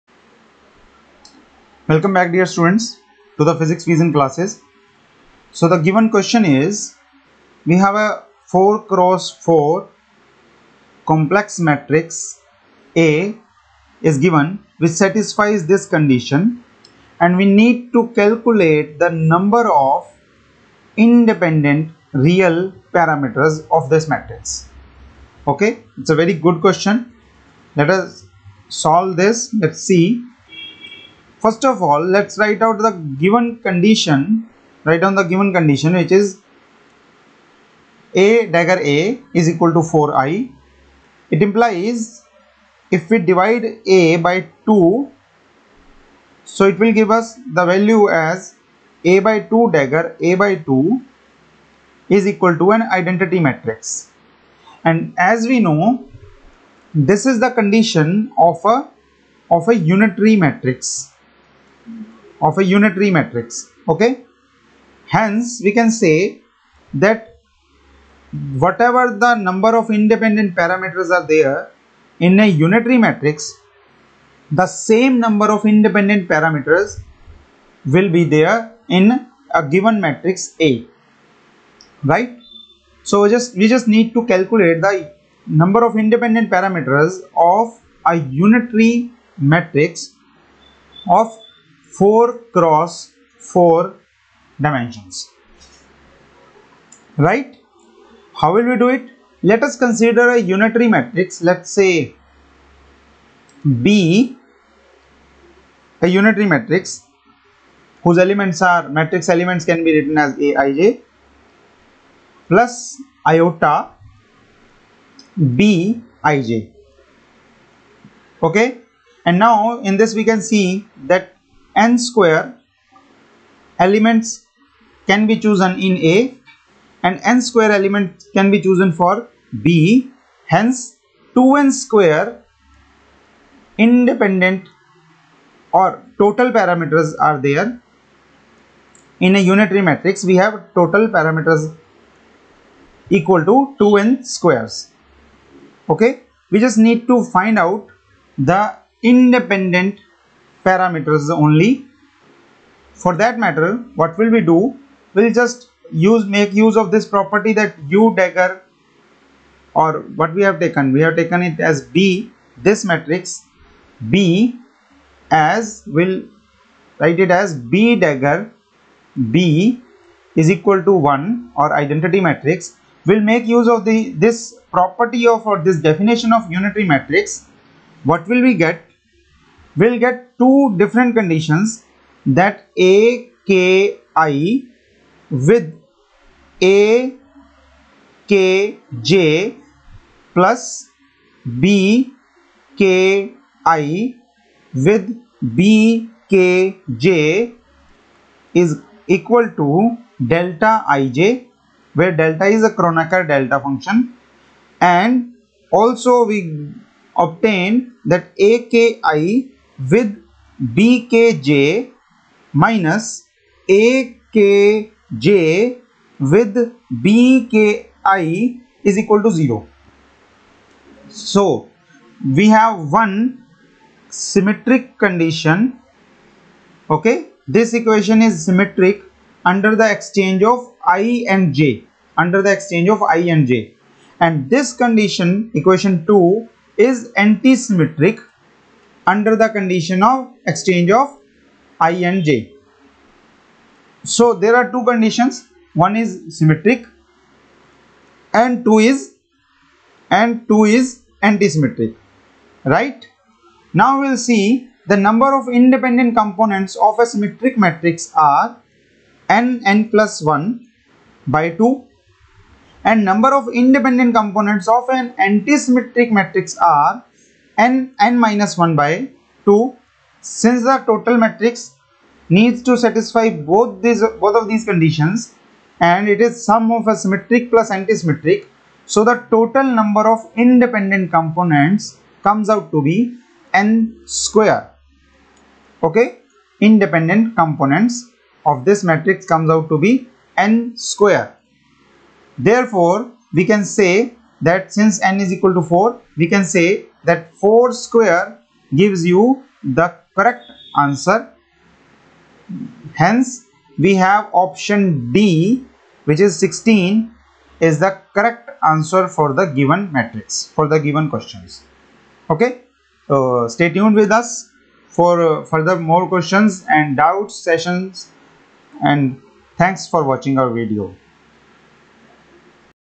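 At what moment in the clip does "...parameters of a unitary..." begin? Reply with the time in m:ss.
1:26.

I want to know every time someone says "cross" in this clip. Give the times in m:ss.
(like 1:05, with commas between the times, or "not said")
0:08, 1:32.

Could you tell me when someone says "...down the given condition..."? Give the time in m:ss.
0:35.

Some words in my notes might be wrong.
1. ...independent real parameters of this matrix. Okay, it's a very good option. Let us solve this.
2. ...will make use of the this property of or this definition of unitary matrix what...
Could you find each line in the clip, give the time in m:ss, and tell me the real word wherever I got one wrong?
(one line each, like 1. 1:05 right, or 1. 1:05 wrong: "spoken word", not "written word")
1. 0:20 wrong: "question", not "option"
2. 2:53 right.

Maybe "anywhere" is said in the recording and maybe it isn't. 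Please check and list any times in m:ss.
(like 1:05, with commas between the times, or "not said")
not said.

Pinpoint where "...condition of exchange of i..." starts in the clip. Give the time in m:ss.
3:59.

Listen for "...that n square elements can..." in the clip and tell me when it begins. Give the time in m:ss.
2:01.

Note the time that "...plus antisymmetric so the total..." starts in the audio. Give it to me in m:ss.
4:37.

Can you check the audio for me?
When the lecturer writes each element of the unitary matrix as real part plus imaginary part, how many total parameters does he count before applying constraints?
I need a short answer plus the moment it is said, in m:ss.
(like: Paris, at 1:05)
2n squared, at 2:11.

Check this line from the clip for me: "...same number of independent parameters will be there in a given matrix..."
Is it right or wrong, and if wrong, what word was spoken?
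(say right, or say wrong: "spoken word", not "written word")
right.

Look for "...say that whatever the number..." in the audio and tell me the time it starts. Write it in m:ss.
1:06.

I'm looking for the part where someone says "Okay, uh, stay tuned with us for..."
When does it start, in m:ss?
5:12.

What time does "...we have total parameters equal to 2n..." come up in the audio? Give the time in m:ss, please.
2:20.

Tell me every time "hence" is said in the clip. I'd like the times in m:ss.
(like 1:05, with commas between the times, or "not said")
1:05, 2:10, 5:02.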